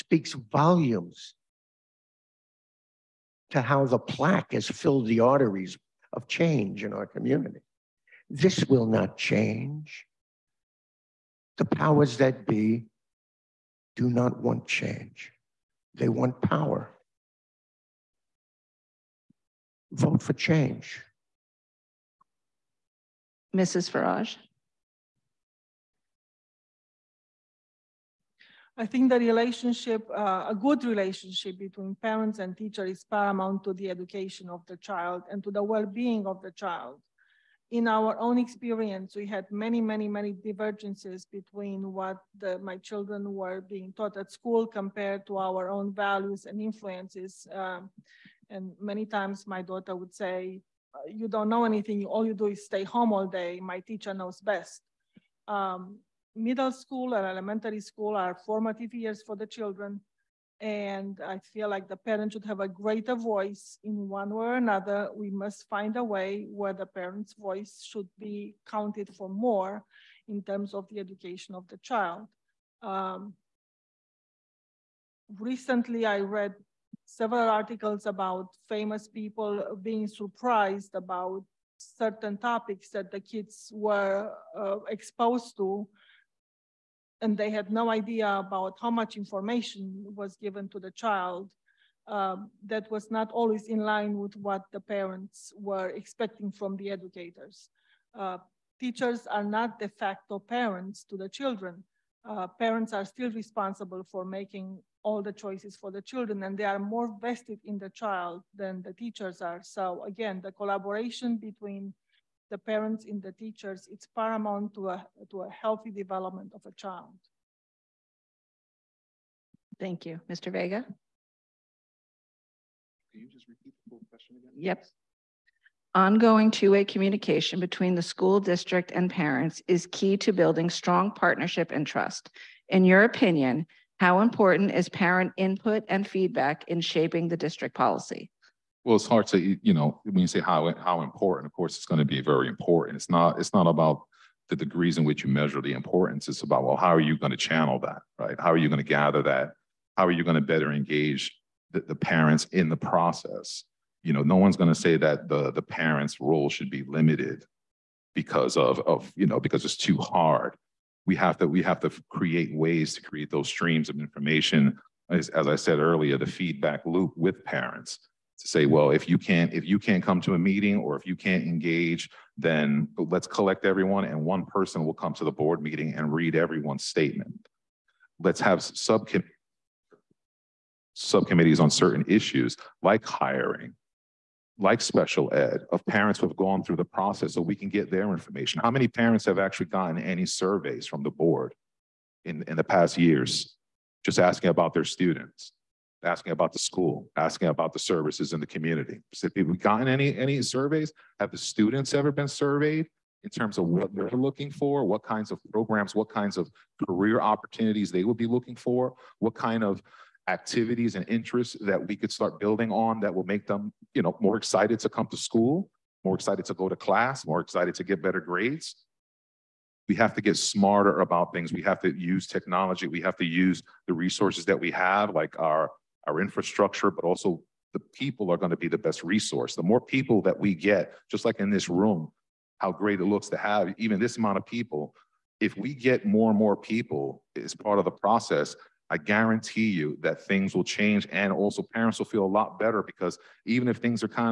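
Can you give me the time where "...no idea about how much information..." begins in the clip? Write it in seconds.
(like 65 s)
87 s.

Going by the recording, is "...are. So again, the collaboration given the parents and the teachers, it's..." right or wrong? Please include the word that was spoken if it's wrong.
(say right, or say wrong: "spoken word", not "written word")
wrong: "between", not "given".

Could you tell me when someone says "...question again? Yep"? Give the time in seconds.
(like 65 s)
124 s.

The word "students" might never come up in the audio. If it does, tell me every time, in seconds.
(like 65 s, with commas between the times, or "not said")
194 s, 201 s.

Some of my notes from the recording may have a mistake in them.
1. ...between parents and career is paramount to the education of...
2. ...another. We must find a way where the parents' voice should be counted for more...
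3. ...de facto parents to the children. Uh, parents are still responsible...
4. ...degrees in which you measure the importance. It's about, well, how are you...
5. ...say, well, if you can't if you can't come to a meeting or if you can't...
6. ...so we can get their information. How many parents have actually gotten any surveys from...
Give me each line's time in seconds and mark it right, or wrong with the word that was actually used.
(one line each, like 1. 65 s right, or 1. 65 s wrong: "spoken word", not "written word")
1. 31 s wrong: "teacher", not "career"
2. 64 s right
3. 99 s right
4. 144 s right
5. 168 s right
6. 187 s right.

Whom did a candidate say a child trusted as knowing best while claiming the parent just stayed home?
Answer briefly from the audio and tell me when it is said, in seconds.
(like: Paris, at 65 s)
My teacher, at 53 s.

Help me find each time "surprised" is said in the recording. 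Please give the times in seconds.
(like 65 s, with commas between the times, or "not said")
80 s.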